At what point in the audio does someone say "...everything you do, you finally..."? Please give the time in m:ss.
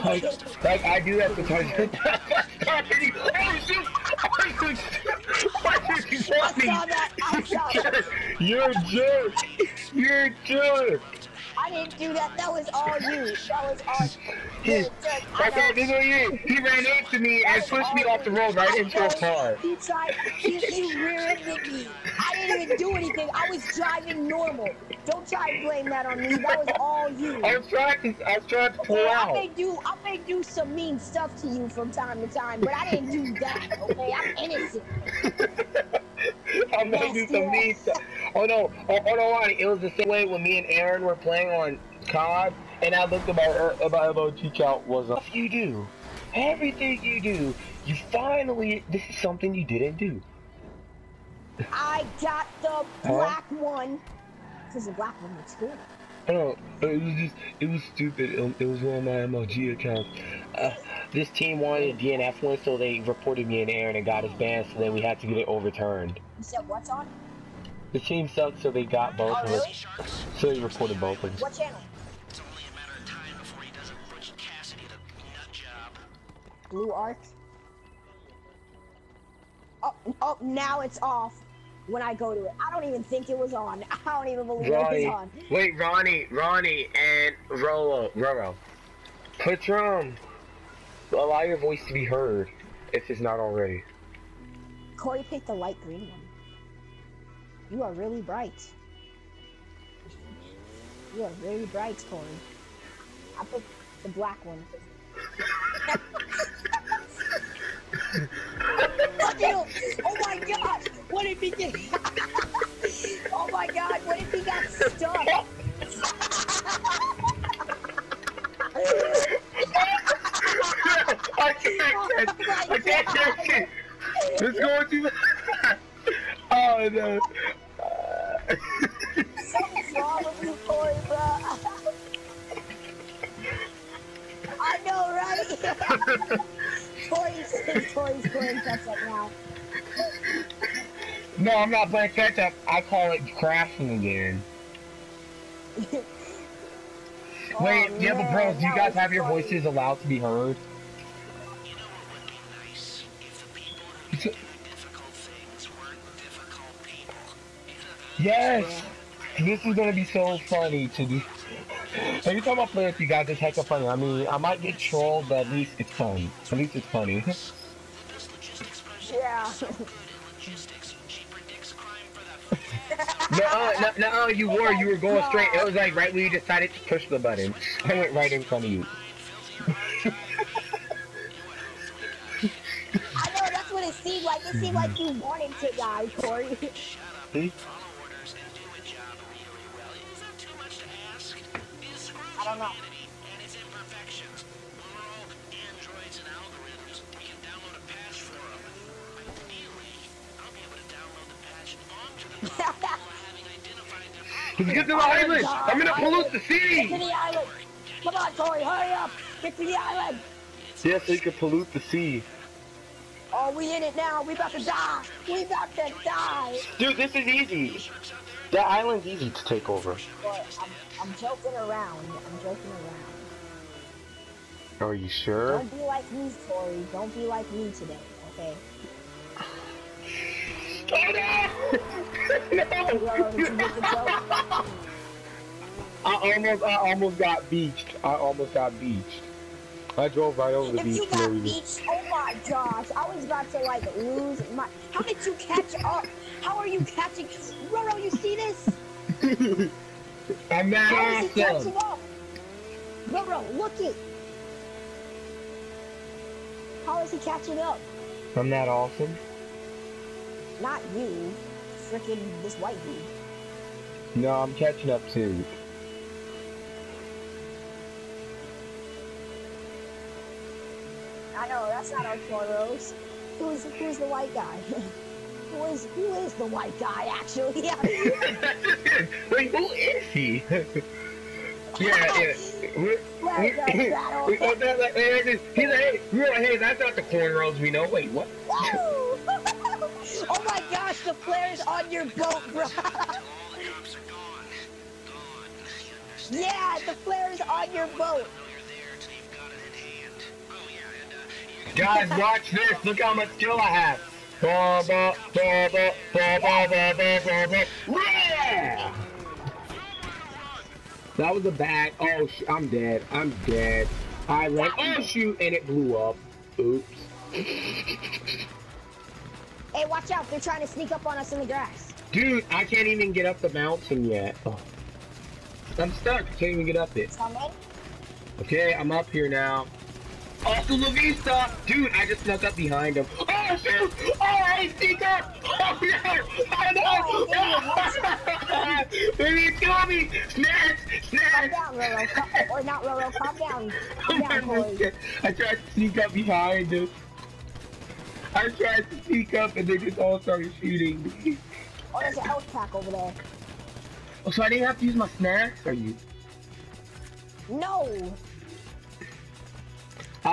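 0:46.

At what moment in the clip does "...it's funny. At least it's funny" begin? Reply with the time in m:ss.
2:45.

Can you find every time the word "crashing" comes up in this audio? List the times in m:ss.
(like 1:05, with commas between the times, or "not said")
2:23.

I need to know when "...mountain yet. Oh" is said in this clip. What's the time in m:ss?
5:23.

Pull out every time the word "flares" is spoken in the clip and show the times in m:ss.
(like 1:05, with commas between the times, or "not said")
4:51, 4:57.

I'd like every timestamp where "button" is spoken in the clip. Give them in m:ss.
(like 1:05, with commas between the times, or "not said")
2:57.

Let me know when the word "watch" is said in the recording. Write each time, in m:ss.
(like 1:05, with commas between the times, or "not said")
5:02, 5:19.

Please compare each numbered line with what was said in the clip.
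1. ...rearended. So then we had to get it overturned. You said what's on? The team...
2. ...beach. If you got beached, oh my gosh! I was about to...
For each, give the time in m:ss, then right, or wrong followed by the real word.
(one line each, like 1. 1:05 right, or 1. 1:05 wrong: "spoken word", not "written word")
1. 1:04 wrong: "banned", not "rearended"
2. 4:00 right.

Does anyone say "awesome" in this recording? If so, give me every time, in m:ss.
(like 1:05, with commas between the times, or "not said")
4:11, 4:18.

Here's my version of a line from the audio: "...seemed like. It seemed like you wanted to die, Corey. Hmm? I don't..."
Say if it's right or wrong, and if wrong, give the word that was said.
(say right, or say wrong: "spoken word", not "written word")
right.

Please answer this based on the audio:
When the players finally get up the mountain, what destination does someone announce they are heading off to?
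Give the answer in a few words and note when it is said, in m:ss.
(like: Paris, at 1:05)
La Vista, at 5:30.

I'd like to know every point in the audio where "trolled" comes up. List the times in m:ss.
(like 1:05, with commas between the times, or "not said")
2:44.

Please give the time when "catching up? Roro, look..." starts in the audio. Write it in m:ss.
4:11.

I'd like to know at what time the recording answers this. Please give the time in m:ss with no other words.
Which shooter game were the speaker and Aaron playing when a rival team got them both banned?
0:42.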